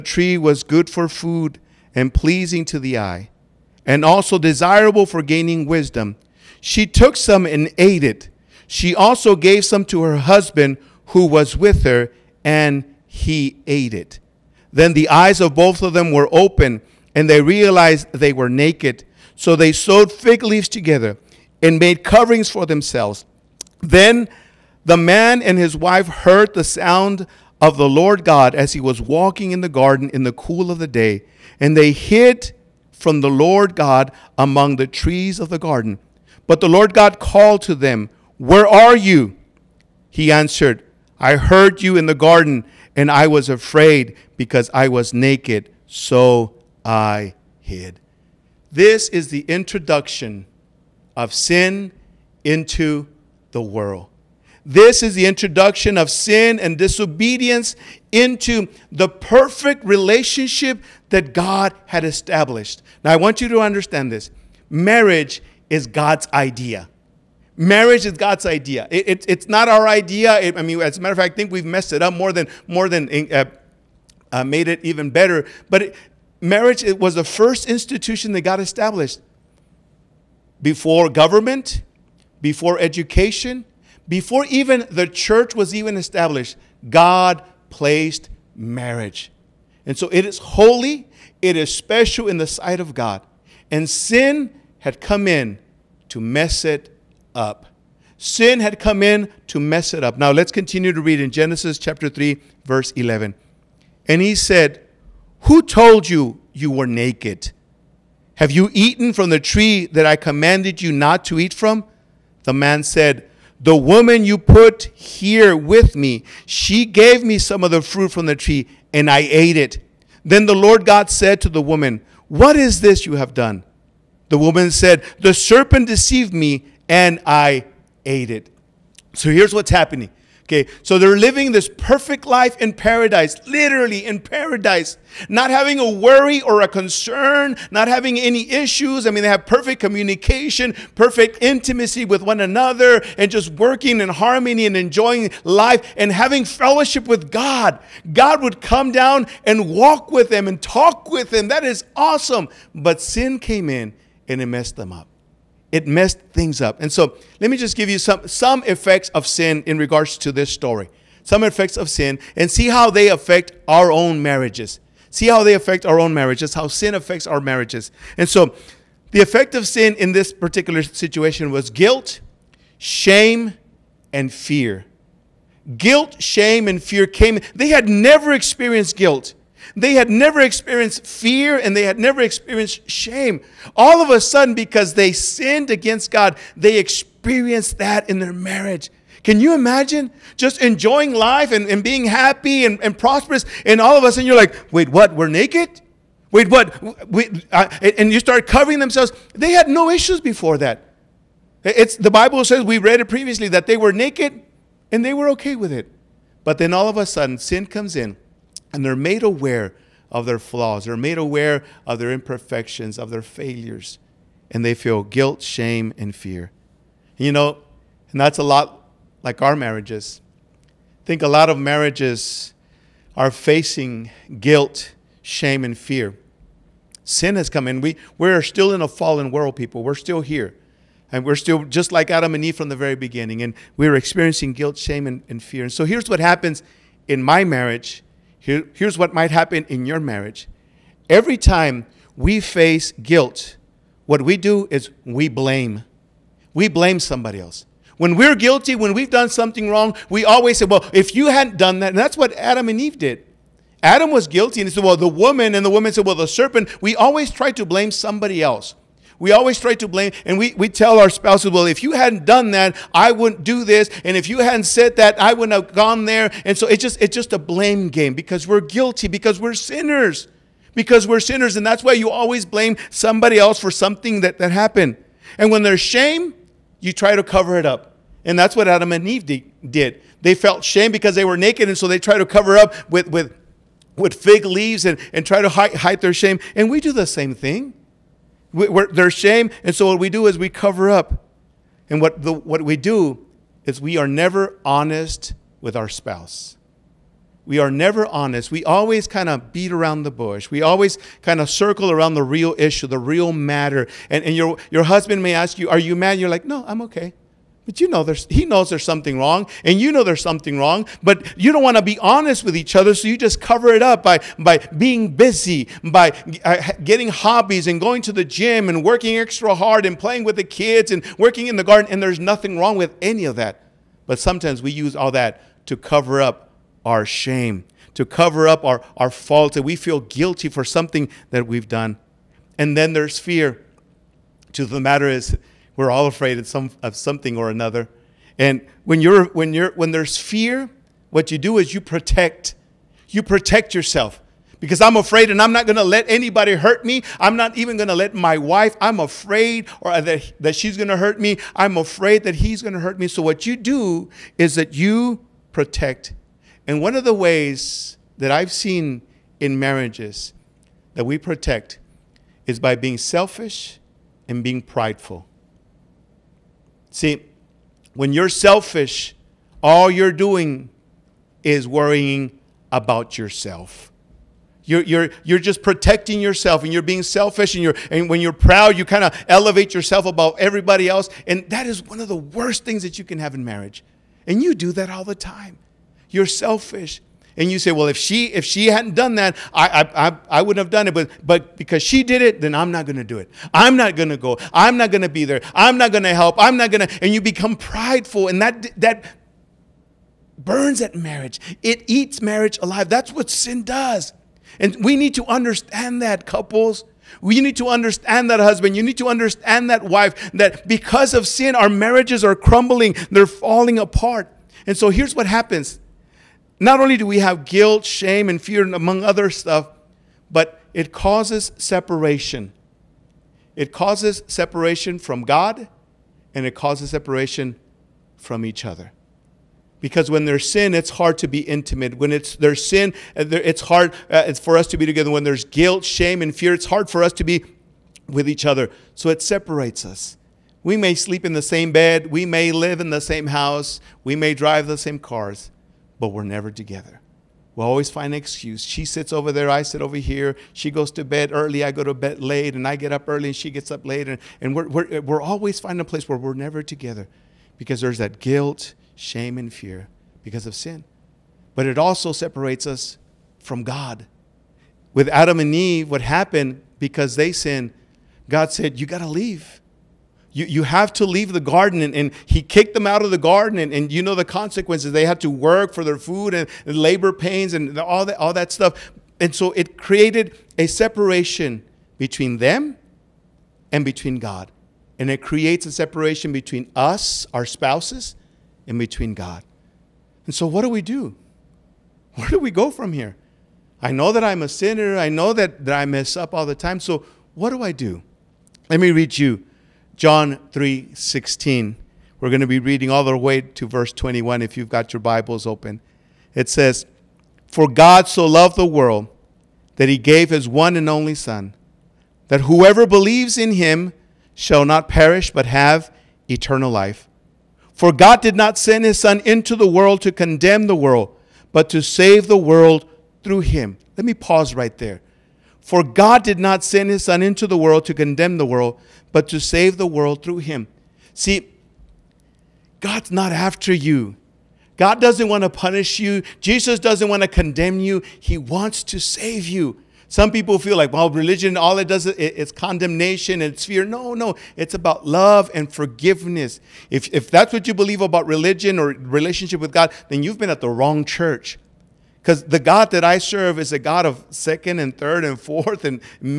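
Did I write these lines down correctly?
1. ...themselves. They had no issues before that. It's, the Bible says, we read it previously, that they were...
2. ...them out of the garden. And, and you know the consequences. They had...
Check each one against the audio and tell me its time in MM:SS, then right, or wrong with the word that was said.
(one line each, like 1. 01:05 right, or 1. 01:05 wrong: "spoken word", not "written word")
1. 03:18 right
2. 07:52 right.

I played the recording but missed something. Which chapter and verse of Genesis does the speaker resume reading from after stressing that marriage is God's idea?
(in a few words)
Genesis 3:11.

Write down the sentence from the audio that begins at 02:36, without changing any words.
And so let me just give you some, some effects of sin in regards to this story.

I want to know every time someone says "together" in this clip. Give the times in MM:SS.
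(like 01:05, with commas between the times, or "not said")
00:20, 07:14, 07:26, 07:36.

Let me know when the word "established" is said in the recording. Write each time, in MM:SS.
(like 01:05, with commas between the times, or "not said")
01:02, 01:18, 01:25.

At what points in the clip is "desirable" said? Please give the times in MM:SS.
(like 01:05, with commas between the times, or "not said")
00:04.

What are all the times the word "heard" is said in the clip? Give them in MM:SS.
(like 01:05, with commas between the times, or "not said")
00:26, 00:41.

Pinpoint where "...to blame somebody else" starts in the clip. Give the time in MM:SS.
04:17.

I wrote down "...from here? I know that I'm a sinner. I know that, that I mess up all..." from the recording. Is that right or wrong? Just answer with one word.
right.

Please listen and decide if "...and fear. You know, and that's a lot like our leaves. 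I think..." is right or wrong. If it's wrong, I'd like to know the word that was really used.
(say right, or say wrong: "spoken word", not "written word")
wrong: "marriages", not "leaves".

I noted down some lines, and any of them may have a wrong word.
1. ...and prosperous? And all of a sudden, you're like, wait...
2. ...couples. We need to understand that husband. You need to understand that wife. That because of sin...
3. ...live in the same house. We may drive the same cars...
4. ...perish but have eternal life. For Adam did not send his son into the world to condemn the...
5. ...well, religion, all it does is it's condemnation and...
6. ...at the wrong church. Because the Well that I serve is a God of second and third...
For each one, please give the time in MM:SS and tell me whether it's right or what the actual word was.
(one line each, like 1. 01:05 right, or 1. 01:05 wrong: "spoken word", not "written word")
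1. 03:12 right
2. 06:46 right
3. 07:22 right
4. 08:34 wrong: "God", not "Adam"
5. 09:00 right
6. 09:10 wrong: "God", not "Well".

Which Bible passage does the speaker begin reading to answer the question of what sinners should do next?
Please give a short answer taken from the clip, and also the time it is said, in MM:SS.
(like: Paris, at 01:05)
John 3:16, at 08:19.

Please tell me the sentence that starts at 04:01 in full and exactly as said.
Every time we face guilt, what we do is we blame.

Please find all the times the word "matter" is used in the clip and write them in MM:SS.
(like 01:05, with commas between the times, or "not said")
01:11, 05:03, 05:34.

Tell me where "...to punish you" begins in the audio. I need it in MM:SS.
08:55.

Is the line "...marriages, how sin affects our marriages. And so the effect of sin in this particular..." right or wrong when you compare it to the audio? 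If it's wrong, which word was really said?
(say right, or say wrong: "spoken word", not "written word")
right.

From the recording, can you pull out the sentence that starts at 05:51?
I'm afraid that he's going to hurt me.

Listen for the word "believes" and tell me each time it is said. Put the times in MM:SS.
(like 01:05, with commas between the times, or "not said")
08:32, 09:07.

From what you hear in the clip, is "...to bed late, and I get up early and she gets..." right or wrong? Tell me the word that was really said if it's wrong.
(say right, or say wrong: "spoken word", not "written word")
right.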